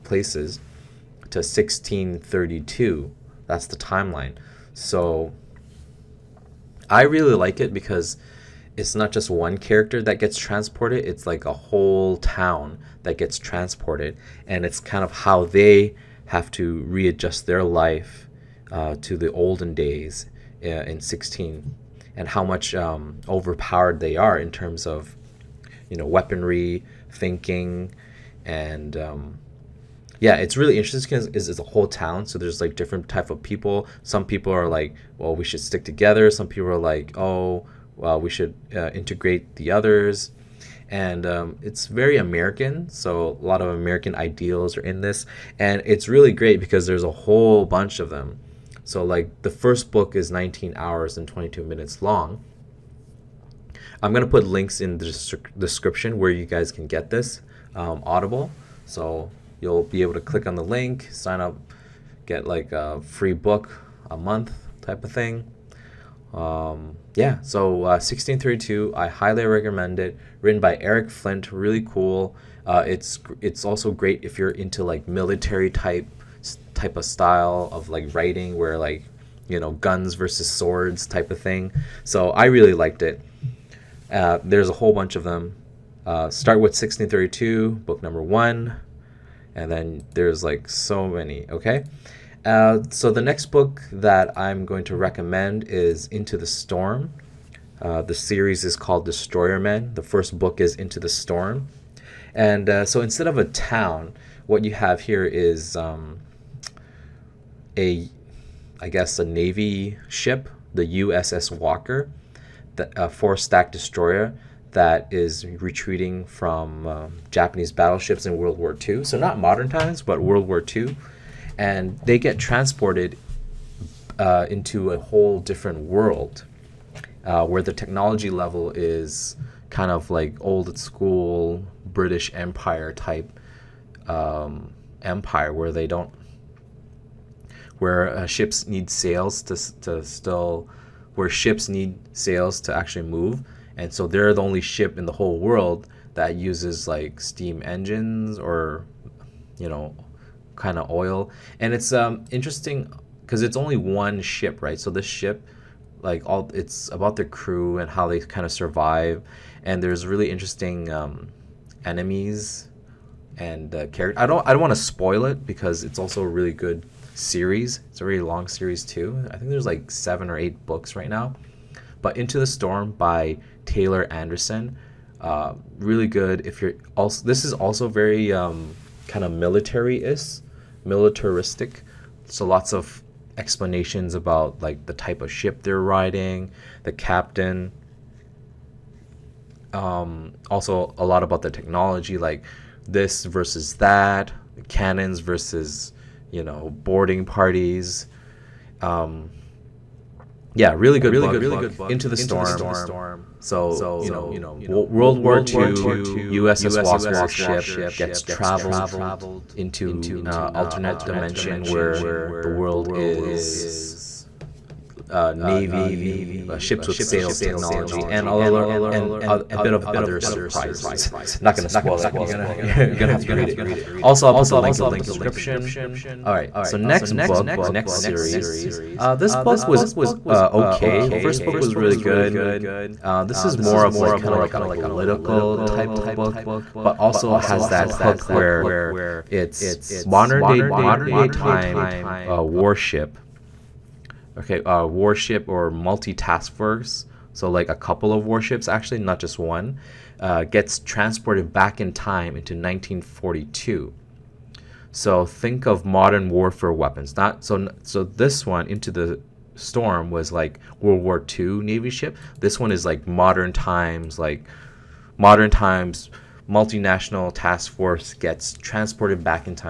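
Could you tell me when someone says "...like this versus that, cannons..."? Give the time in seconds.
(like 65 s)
192 s.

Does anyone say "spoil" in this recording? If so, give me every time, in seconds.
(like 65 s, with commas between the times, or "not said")
164 s, 221 s.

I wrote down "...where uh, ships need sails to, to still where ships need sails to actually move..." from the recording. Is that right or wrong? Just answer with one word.
right.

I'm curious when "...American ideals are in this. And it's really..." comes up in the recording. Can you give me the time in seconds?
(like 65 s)
43 s.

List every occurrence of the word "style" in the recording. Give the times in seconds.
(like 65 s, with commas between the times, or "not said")
77 s.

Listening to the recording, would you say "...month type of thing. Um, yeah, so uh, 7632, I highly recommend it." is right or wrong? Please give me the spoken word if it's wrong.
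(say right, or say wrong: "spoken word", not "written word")
wrong: "1632", not "7632".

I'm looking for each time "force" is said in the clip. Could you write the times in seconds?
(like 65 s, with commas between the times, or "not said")
246 s, 267 s.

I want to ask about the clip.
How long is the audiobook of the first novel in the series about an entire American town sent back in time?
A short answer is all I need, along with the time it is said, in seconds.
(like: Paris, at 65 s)
19 hours and 22 minutes, at 50 s.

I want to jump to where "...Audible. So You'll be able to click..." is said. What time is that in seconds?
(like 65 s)
58 s.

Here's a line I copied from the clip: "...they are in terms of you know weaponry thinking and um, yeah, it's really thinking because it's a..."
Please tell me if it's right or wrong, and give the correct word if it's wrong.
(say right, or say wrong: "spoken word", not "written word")
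wrong: "interesting", not "thinking".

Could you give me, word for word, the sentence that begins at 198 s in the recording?
Um, yeah, really good book into the storm.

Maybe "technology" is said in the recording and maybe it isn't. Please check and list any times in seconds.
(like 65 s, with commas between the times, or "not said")
127 s, 191 s, 217 s.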